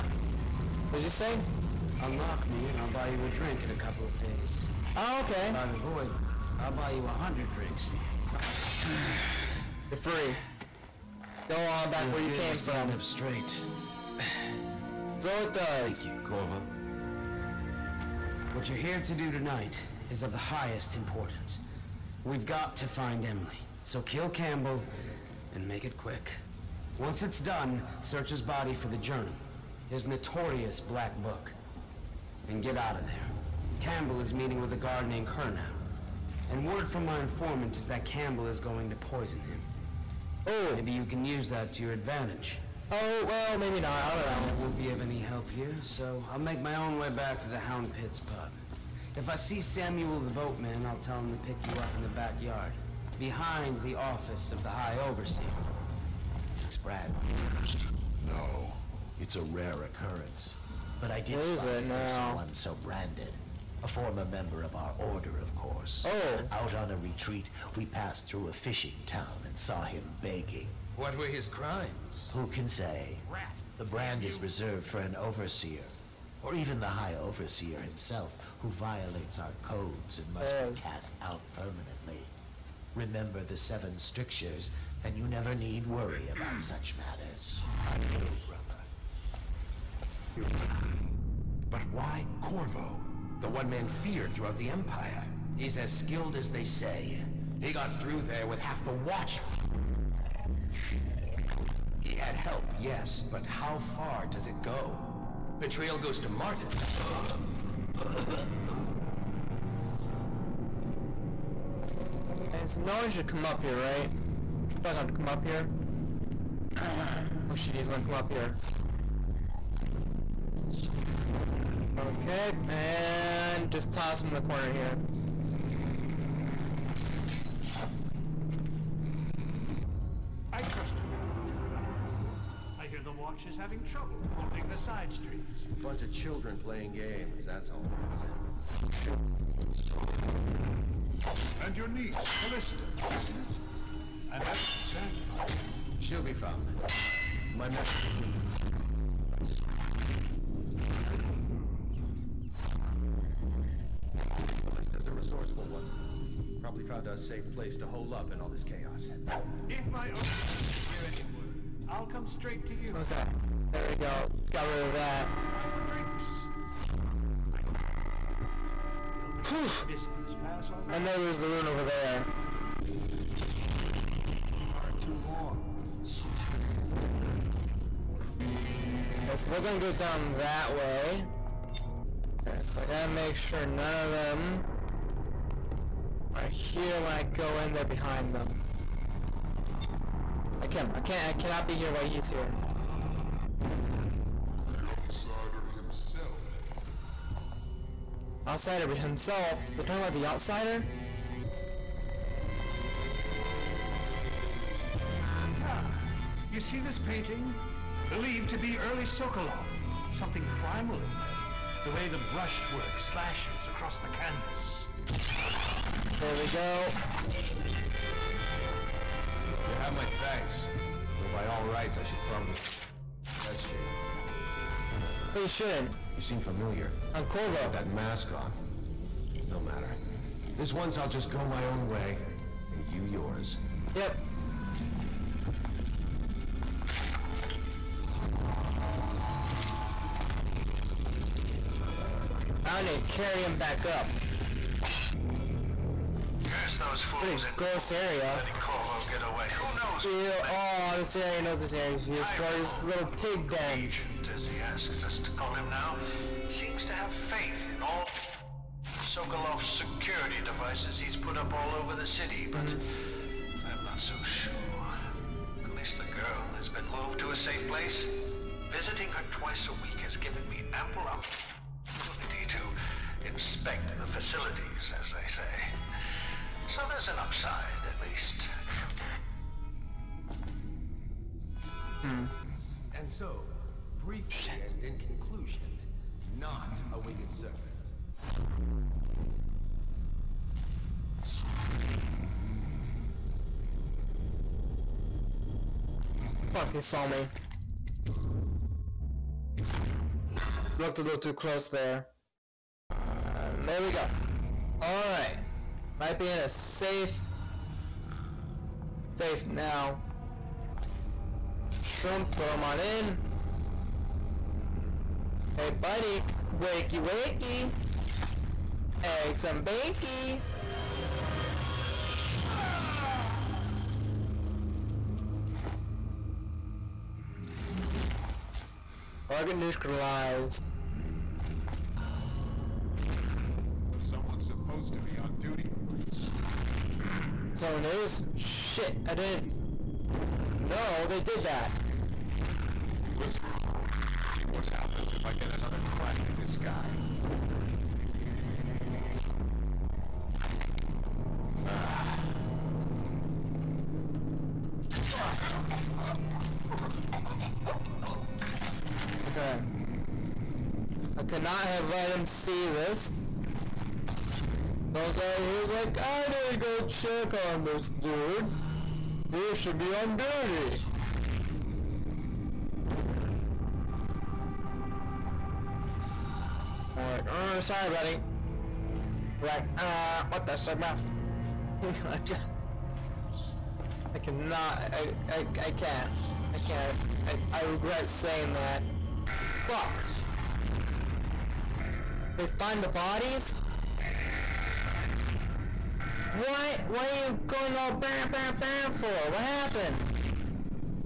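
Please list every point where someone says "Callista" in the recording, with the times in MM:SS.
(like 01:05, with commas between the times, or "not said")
02:22, 02:34.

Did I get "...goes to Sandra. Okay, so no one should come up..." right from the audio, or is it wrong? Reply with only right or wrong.
wrong.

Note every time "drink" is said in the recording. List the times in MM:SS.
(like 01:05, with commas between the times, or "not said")
00:03, 00:07.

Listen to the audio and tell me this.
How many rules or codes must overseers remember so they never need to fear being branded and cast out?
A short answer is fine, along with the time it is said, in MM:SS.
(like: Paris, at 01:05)
7, at 01:23.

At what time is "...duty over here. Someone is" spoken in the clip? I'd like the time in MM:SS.
05:35.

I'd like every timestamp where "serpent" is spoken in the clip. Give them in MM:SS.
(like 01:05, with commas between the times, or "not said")
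04:47.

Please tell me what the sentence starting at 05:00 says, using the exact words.
Looked a little too close there.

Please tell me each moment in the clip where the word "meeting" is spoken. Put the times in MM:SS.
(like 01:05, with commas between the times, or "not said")
00:34.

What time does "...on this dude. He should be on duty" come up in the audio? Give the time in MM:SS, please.
06:07.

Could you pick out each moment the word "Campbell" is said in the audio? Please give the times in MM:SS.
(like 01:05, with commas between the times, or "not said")
00:24, 00:33, 00:38.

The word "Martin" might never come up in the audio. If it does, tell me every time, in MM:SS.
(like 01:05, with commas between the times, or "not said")
01:46.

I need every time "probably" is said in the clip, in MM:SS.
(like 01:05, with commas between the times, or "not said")
02:36, 03:42.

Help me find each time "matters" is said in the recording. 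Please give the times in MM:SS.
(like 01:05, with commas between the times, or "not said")
01:27, 03:49.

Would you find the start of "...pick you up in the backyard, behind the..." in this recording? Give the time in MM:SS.
00:51.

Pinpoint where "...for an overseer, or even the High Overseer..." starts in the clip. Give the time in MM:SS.
01:14.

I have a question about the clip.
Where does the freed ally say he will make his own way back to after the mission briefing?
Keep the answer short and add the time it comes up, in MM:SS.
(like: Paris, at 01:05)
Hound Pits pub, at 00:47.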